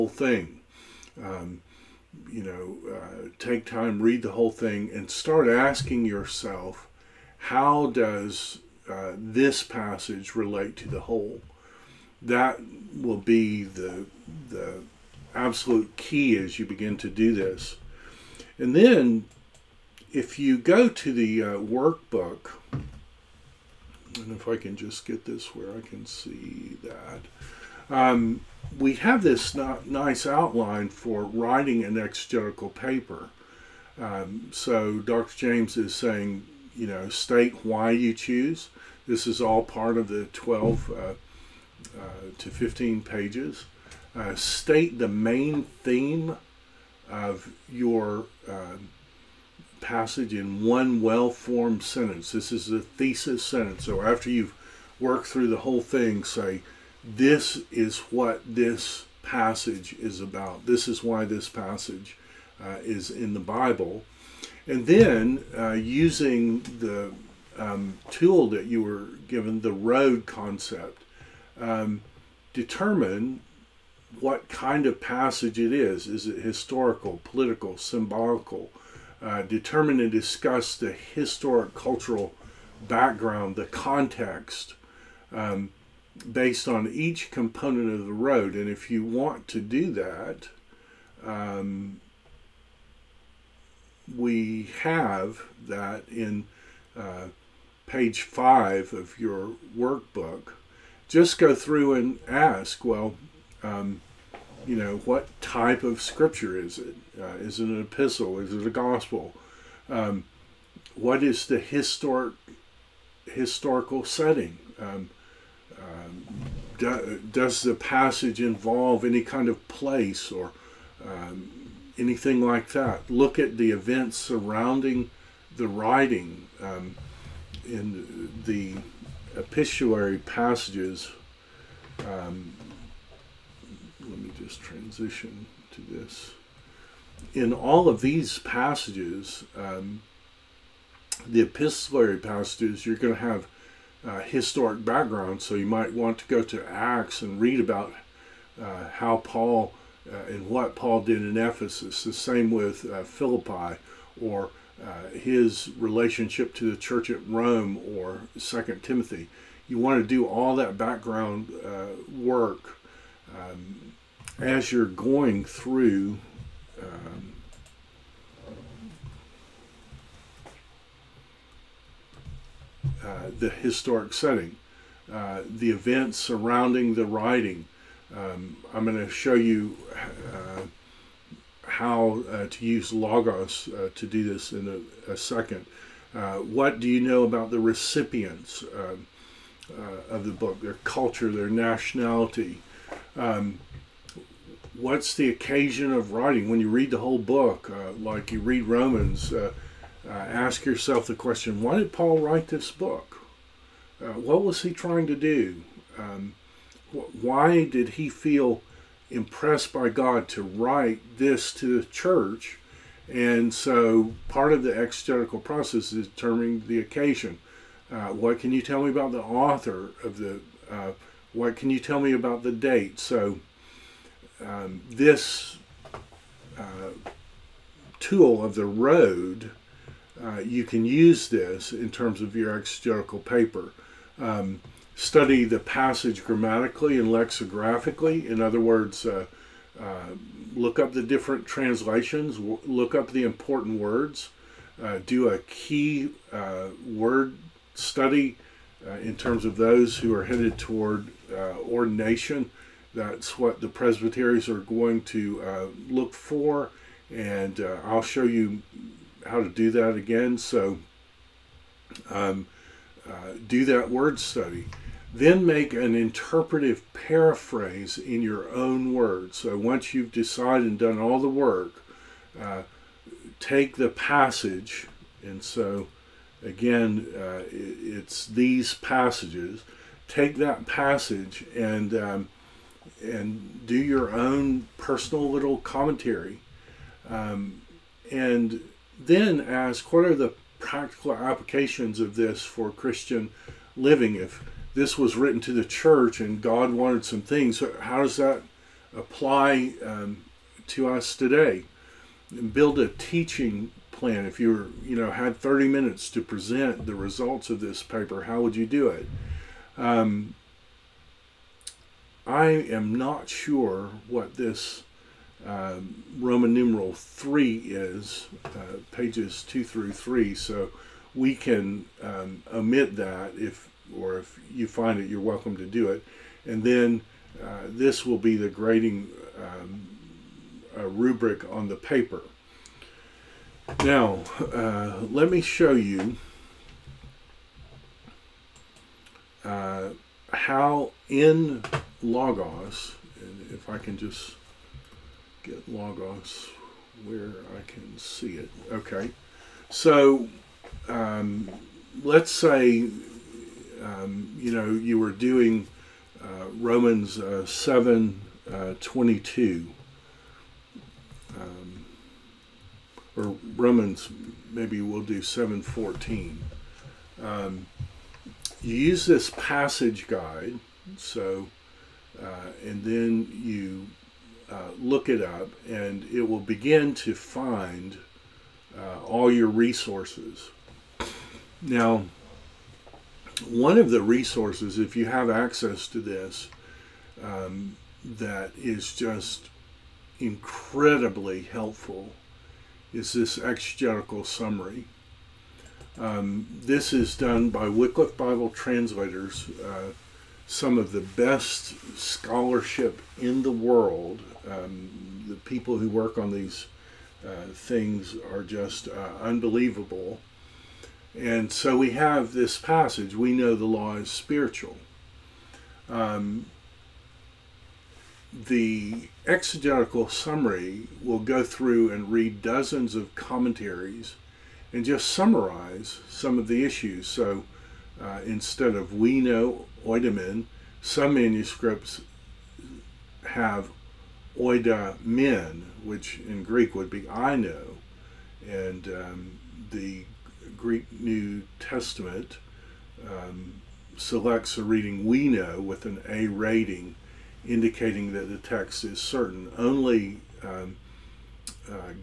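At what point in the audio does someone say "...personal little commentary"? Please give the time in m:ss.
4:44.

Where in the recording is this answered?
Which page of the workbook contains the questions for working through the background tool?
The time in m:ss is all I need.
1:37.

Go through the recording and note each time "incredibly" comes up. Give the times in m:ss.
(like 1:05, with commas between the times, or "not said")
6:30.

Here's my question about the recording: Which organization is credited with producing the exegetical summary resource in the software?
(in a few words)
Wycliffe Bible Translators.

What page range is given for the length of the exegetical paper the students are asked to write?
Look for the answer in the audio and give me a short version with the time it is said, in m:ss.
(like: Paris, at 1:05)
12 to 15 pages, at 0:40.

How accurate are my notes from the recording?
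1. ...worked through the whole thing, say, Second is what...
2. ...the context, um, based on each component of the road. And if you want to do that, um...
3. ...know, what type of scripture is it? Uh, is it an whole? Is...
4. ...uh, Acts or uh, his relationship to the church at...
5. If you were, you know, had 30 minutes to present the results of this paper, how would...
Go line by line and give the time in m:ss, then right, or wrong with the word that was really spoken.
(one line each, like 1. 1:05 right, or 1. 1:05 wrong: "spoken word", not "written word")
1. 0:54 wrong: "This", not "Second"
2. 1:23 right
3. 1:44 wrong: "epistle", not "whole"
4. 2:32 wrong: "Philippi", not "Acts"
5. 5:04 right.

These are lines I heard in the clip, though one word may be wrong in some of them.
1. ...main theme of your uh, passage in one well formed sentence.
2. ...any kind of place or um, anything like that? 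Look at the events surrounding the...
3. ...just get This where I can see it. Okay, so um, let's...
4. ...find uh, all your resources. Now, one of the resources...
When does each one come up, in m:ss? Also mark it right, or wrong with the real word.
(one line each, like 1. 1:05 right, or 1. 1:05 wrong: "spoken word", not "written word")
1. 0:45 right
2. 1:59 right
3. 5:43 wrong: "Logos", not "This"
4. 6:17 right.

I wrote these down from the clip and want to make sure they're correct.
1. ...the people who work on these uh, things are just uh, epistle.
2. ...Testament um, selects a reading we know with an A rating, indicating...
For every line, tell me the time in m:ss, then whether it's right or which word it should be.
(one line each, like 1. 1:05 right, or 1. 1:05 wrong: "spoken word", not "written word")
1. 6:45 wrong: "unbelievable", not "epistle"
2. 7:21 right.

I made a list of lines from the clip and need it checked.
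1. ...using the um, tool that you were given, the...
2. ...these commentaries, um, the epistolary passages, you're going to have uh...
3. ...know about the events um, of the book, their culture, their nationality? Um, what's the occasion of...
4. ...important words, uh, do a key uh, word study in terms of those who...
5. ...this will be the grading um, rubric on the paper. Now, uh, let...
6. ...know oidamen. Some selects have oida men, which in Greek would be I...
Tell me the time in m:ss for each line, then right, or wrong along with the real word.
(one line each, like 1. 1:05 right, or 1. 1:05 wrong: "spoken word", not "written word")
1. 1:05 right
2. 2:18 wrong: "passages", not "commentaries"
3. 3:06 wrong: "recipients", not "events"
4. 4:03 right
5. 5:27 right
6. 7:09 wrong: "manuscripts", not "selects".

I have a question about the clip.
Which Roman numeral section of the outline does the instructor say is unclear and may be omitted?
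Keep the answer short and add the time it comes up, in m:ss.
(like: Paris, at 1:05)
3, at 5:16.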